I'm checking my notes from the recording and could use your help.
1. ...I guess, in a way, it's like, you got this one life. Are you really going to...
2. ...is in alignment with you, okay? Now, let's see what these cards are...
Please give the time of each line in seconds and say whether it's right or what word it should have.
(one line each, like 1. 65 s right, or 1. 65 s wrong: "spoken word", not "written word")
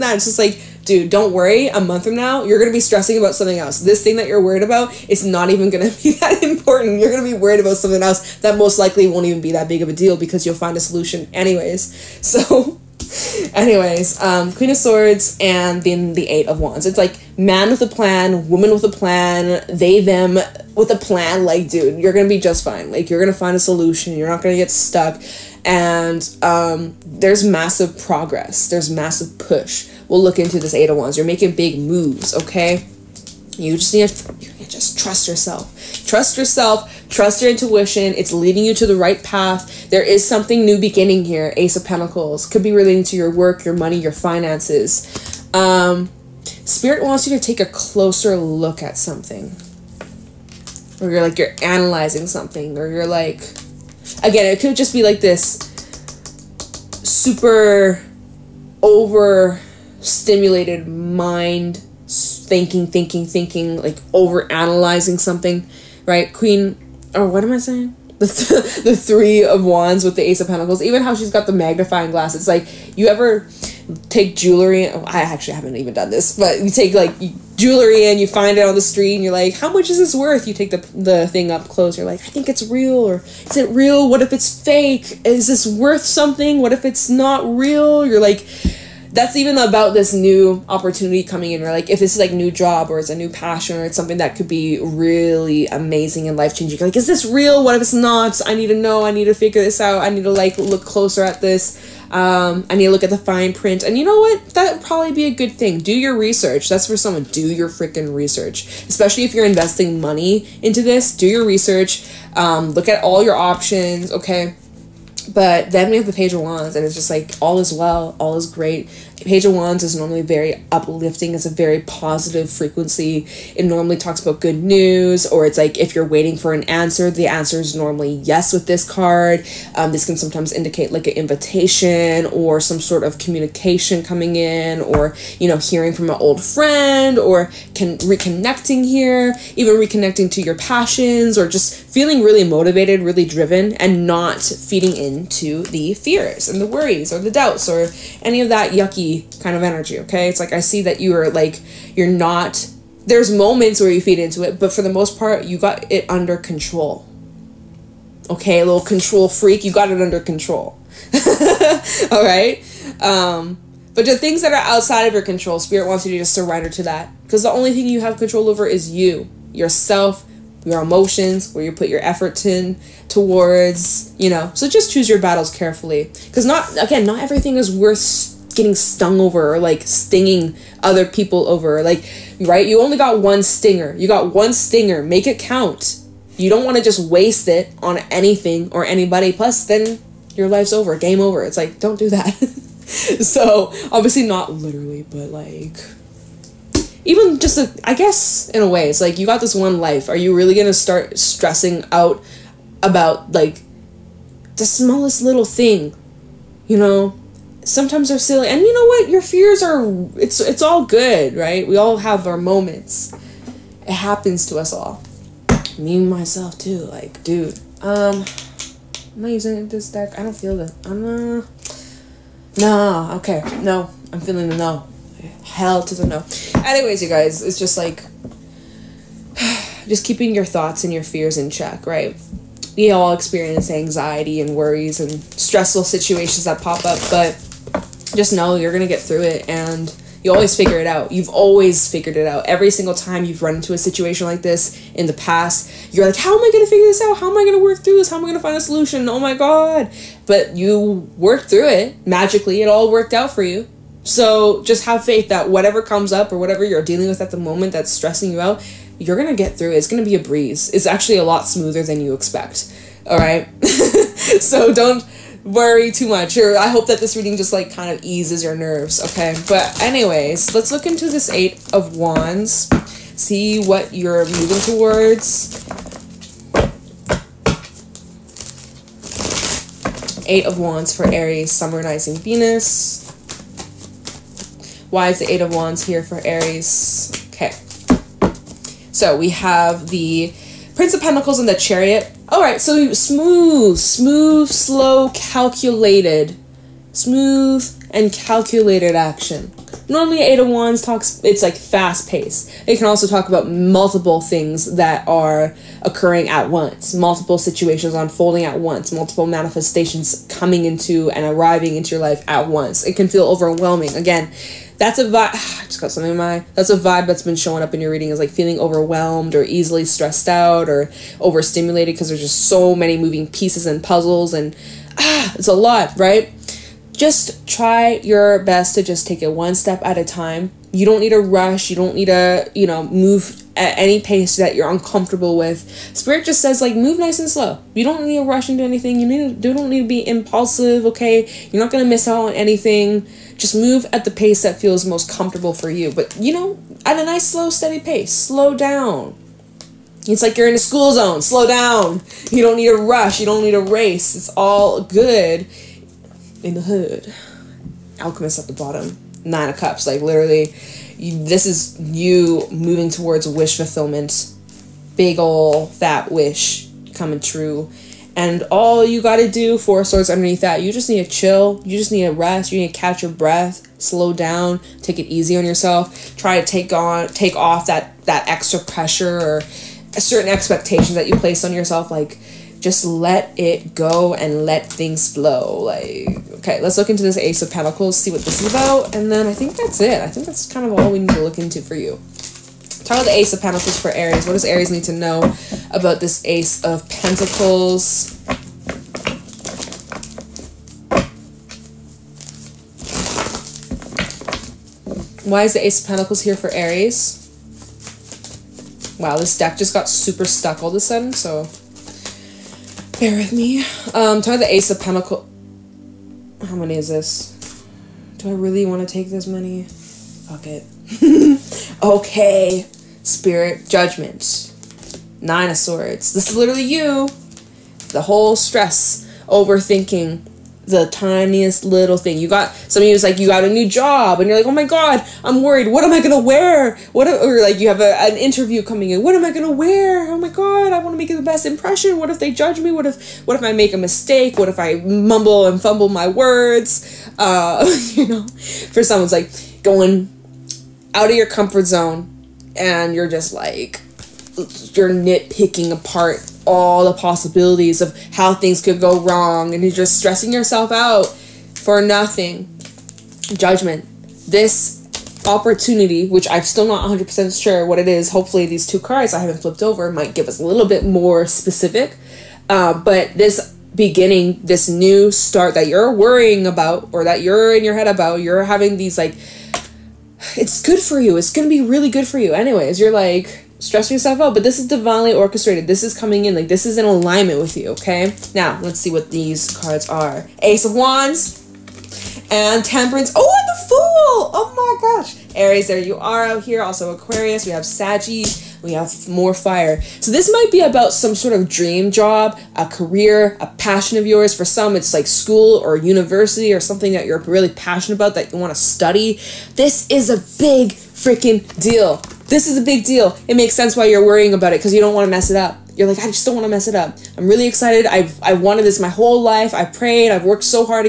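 1. 197 s right
2. 486 s right.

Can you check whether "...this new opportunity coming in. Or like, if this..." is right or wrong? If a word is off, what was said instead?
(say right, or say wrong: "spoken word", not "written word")
right.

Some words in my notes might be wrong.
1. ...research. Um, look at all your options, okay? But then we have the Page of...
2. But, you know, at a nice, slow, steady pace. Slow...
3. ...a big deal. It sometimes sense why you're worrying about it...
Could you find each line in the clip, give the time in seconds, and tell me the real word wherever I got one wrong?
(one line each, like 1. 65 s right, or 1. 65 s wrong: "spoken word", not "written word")
1. 111 s right
2. 345 s right
3. 512 s wrong: "makes", not "sometimes".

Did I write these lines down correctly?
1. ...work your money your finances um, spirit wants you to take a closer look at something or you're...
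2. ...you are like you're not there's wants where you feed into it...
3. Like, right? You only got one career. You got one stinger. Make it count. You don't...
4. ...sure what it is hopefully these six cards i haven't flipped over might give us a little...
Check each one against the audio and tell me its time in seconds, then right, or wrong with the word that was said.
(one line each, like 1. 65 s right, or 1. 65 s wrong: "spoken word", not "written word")
1. 43 s right
2. 150 s wrong: "moments", not "wants"
3. 181 s wrong: "stinger", not "career"
4. 467 s wrong: "two", not "six".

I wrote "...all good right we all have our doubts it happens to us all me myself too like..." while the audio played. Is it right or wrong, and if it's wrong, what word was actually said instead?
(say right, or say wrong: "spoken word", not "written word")
wrong: "moments", not "doubts".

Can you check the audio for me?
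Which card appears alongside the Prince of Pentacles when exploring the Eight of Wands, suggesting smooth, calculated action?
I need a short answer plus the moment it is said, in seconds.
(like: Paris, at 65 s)
The Chariot, at 291 s.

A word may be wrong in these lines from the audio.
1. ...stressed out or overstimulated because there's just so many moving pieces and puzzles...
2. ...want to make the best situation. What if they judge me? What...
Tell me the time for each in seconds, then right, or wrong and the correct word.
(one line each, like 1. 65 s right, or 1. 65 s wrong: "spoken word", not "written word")
1. 319 s right
2. 440 s wrong: "impression", not "situation".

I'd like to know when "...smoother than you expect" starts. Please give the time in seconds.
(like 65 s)
261 s.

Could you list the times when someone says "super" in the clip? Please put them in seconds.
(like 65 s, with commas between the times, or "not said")
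57 s, 409 s.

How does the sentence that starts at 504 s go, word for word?
For some, it's like school or university or something that you're really passionate about that you want to study.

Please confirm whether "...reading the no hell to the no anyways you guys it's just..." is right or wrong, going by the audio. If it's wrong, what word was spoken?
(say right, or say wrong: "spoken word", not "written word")
wrong: "feeling", not "reading".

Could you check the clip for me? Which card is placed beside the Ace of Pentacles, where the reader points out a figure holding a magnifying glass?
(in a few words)
Three of Wands.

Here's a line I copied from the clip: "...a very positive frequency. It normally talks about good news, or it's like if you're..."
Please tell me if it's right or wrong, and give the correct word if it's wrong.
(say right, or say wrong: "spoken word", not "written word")
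right.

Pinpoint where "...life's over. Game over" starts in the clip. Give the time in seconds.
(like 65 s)
190 s.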